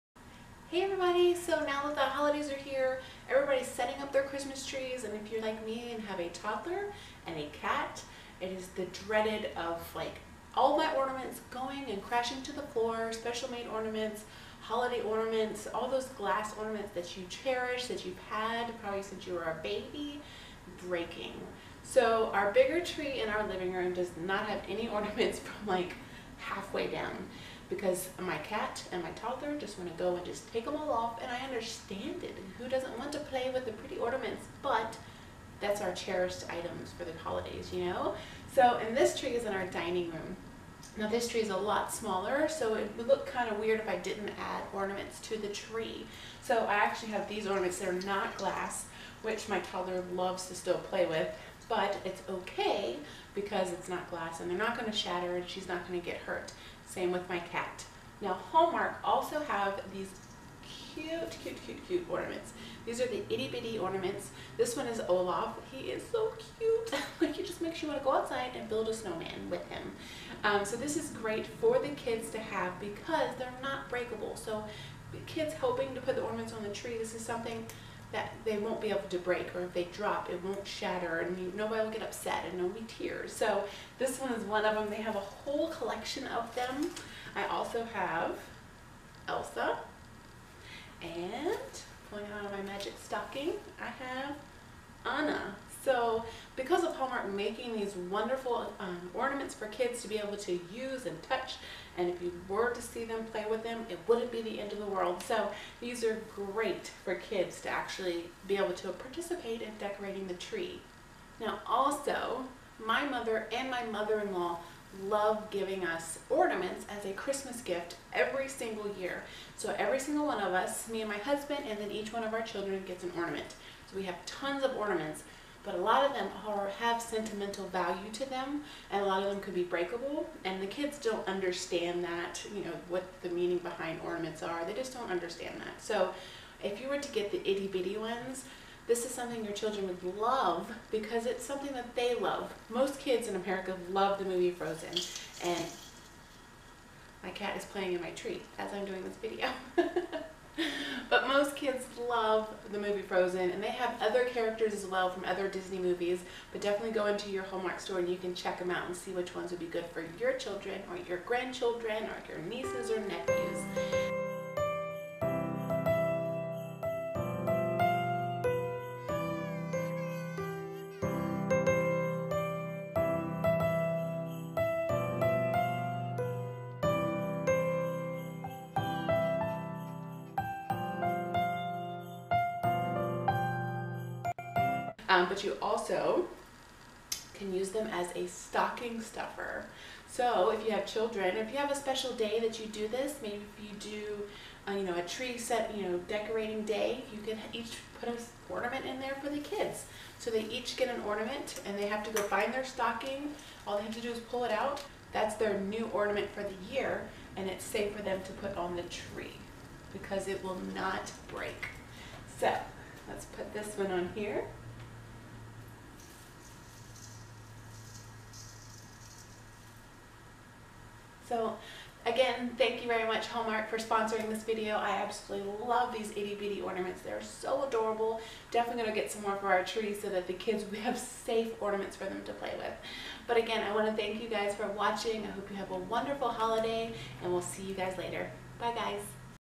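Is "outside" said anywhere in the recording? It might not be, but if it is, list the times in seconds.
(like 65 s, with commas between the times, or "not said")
68 s.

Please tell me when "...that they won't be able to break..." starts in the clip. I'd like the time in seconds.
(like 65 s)
78 s.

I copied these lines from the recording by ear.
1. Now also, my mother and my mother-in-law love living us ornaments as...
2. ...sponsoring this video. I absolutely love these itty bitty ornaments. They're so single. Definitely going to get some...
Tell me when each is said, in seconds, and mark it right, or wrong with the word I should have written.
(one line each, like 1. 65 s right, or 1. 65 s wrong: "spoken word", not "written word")
1. 111 s wrong: "giving", not "living"
2. 223 s wrong: "adorable", not "single".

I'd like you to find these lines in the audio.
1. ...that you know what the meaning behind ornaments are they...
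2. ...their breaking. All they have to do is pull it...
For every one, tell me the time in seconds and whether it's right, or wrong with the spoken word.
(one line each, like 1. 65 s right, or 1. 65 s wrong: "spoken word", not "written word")
1. 132 s right
2. 202 s wrong: "stocking", not "breaking".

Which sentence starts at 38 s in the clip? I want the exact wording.
So, and this tree is in our dining room.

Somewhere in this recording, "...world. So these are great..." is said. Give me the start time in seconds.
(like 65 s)
104 s.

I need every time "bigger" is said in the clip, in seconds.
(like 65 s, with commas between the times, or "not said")
22 s.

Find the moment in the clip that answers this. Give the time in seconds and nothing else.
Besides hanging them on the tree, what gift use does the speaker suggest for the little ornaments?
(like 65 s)
188 s.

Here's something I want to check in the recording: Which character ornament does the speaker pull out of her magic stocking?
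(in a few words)
Anna.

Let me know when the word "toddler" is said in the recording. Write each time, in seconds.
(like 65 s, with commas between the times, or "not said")
6 s, 29 s, 49 s.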